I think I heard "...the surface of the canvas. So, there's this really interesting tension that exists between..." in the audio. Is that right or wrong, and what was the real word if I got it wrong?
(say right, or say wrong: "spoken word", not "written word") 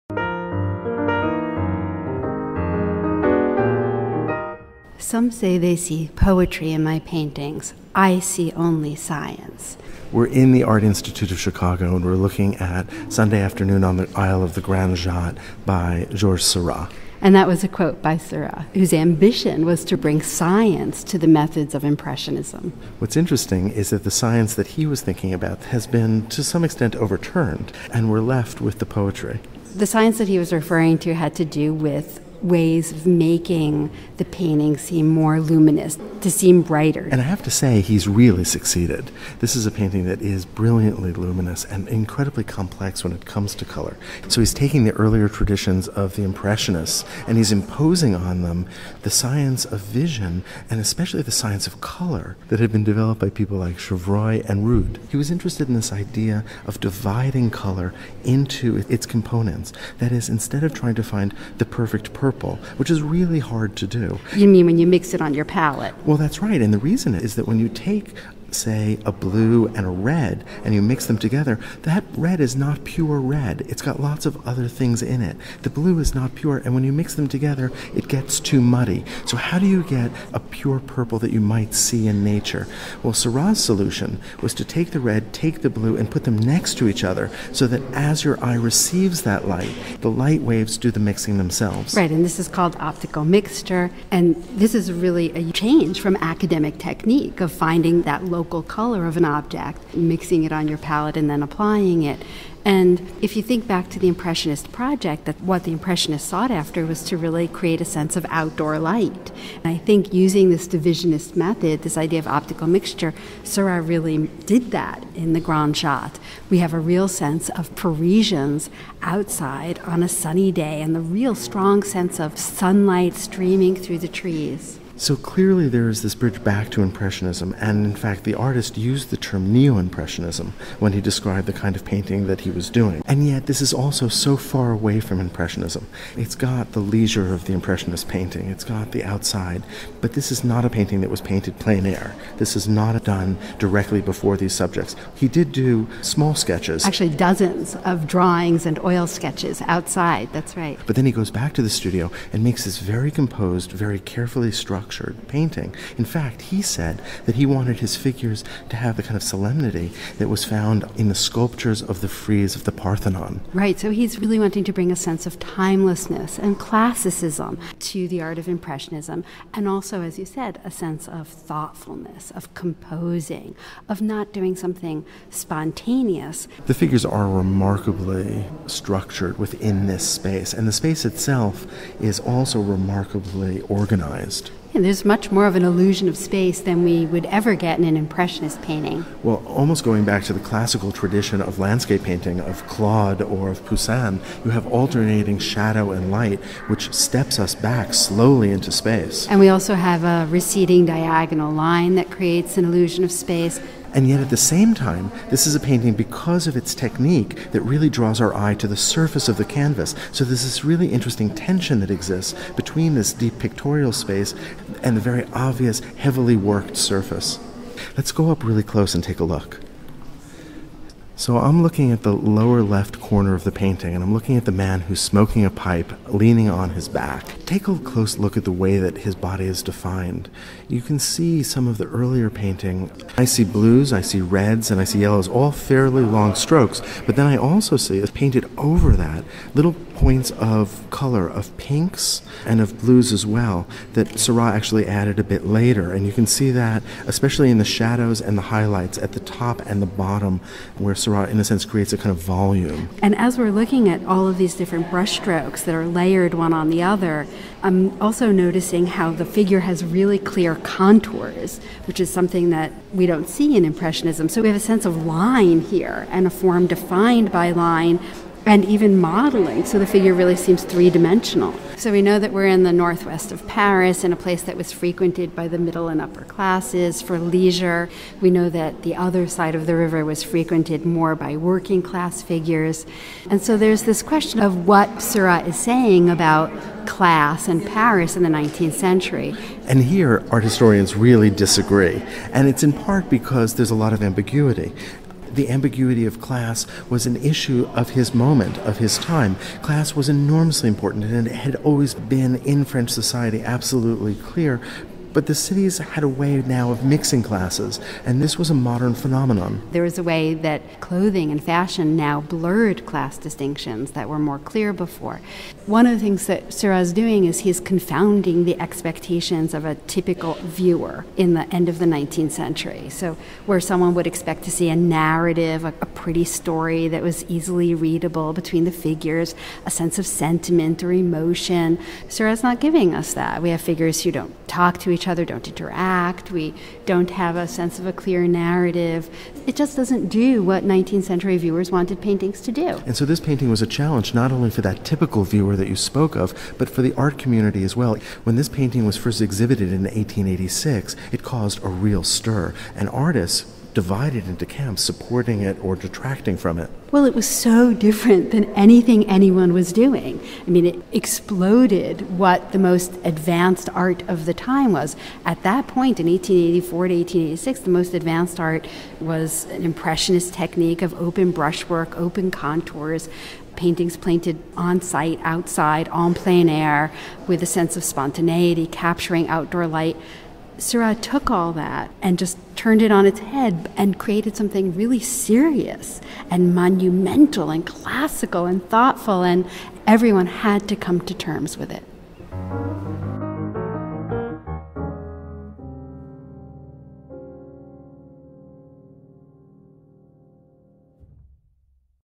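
right.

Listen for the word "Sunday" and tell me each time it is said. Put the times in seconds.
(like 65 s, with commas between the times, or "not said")
13 s.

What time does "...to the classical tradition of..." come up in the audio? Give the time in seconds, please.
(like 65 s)
190 s.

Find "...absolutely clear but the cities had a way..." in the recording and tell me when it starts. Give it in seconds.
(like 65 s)
303 s.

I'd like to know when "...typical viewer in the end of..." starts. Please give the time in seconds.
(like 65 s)
319 s.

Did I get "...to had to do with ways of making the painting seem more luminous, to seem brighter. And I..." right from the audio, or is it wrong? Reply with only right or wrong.
right.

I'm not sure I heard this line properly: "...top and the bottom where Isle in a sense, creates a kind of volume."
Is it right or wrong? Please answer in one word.
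wrong.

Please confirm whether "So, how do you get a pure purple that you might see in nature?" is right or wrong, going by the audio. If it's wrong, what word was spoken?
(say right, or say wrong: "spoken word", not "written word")
right.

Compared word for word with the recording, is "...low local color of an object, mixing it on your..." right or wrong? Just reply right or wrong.
right.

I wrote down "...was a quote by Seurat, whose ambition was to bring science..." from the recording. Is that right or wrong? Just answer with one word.
right.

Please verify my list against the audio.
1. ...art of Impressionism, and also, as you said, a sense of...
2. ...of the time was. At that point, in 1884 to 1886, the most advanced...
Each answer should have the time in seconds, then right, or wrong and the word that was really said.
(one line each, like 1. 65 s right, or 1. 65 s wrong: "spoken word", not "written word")
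1. 168 s right
2. 364 s right.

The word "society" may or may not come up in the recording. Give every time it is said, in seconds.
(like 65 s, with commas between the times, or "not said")
302 s.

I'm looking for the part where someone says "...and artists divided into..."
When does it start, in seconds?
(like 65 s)
352 s.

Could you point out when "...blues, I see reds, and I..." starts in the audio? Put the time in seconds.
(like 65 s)
233 s.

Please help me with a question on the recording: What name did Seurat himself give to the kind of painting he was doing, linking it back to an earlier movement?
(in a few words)
Neo Impressionism.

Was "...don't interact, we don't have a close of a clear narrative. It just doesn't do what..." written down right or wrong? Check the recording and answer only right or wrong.
wrong.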